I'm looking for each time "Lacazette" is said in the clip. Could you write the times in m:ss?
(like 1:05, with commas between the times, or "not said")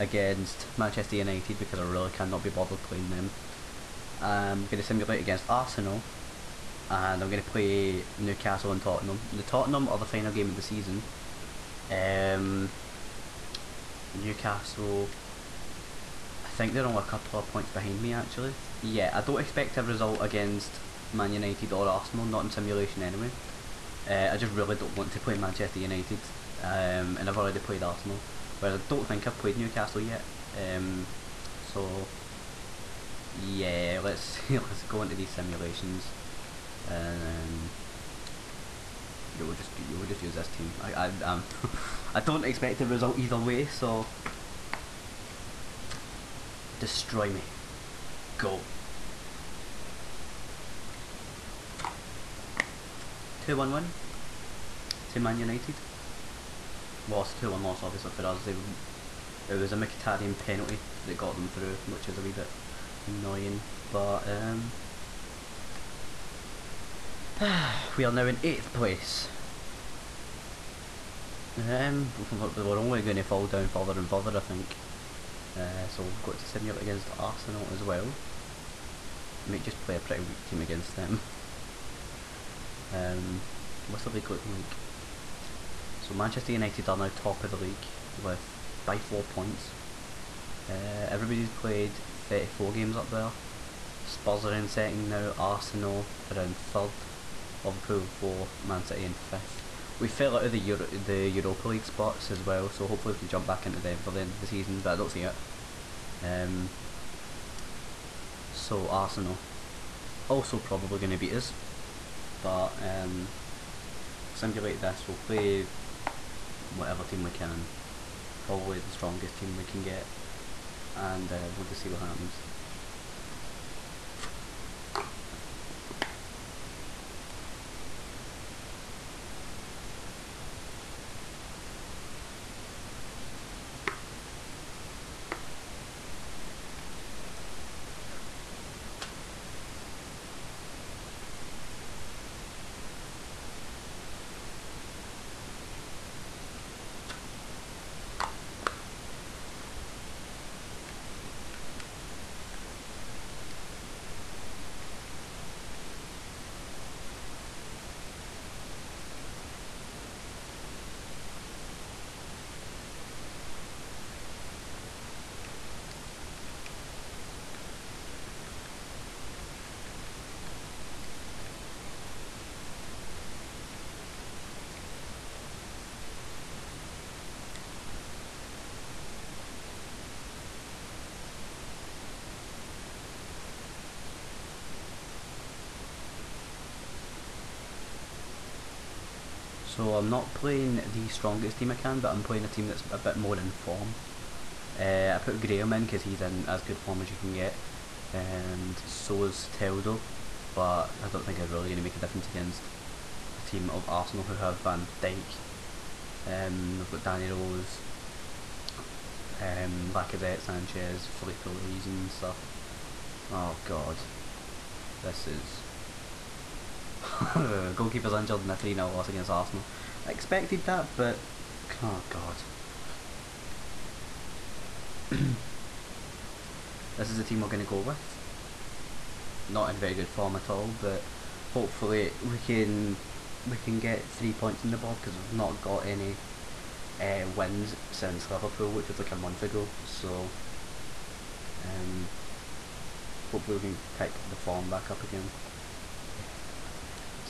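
3:29.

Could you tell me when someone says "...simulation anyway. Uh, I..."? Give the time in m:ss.
0:22.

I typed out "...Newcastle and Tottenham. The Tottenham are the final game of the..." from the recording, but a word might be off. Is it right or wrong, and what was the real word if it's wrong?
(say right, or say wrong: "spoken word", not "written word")
right.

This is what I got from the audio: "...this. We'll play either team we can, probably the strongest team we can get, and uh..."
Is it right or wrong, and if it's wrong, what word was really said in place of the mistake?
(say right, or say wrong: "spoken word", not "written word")
wrong: "whatever", not "either".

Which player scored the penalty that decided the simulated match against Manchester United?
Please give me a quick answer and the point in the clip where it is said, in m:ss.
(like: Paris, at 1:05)
Mkhitaryan, at 0:59.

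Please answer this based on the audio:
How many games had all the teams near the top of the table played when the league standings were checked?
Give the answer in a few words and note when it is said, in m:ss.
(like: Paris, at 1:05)
34, at 1:32.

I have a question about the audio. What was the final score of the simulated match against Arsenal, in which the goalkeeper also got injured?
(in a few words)
3-0.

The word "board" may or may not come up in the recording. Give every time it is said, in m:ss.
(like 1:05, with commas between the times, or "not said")
3:54.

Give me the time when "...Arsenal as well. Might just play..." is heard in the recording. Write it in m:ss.
1:17.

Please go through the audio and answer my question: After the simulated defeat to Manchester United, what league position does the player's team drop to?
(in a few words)
8th.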